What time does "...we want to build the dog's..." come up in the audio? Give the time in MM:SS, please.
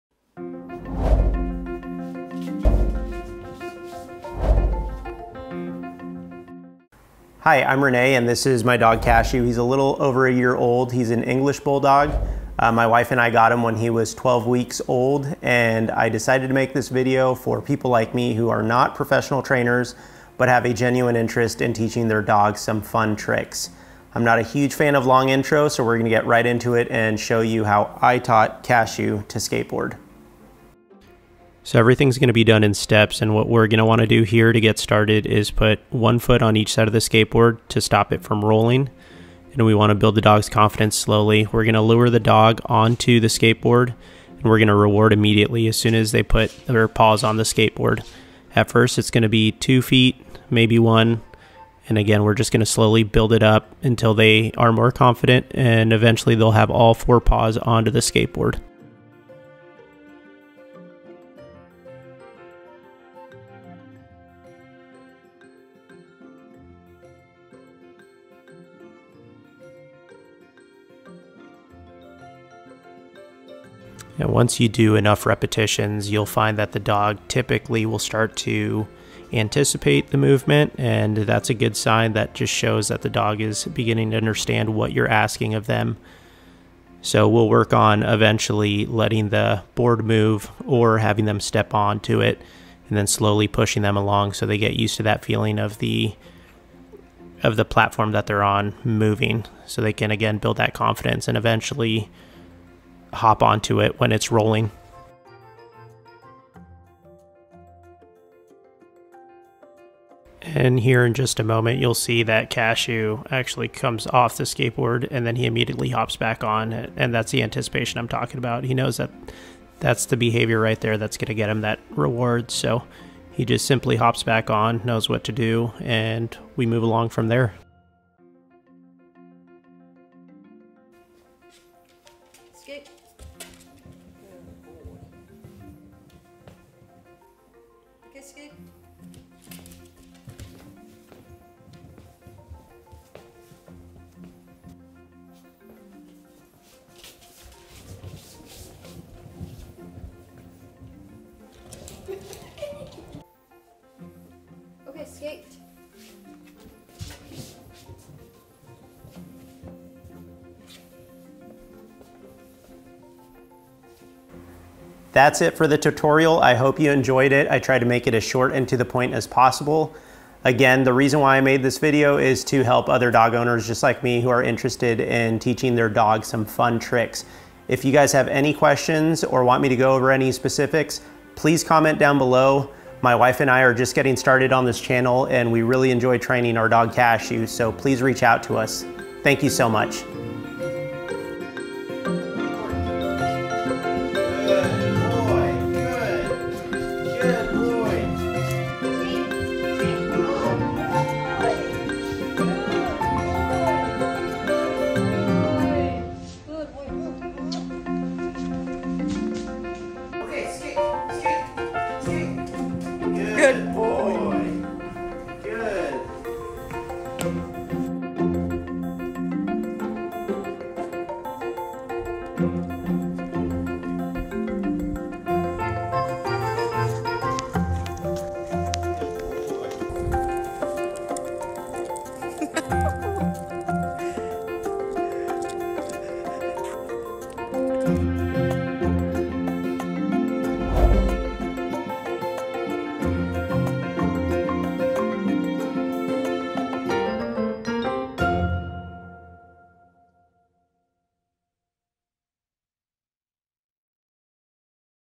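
00:39.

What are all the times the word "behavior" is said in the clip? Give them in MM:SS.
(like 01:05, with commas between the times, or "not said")
02:00.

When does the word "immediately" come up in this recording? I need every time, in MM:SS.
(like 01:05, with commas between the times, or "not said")
00:45, 01:55.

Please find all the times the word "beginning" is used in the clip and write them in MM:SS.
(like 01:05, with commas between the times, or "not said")
01:23.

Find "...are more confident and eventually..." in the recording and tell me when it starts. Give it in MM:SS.
00:54.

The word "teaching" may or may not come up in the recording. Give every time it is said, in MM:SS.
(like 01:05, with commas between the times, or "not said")
00:21, 02:55.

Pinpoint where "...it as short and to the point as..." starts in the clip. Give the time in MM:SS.
02:48.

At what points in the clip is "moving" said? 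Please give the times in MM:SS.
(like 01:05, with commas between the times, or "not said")
01:38.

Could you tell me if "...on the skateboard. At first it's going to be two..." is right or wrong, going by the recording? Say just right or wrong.
right.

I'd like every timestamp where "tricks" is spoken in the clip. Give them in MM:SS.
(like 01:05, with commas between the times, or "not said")
00:23, 02:56.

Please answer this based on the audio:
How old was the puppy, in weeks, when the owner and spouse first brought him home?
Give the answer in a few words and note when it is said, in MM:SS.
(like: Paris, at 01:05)
12 weeks, at 00:14.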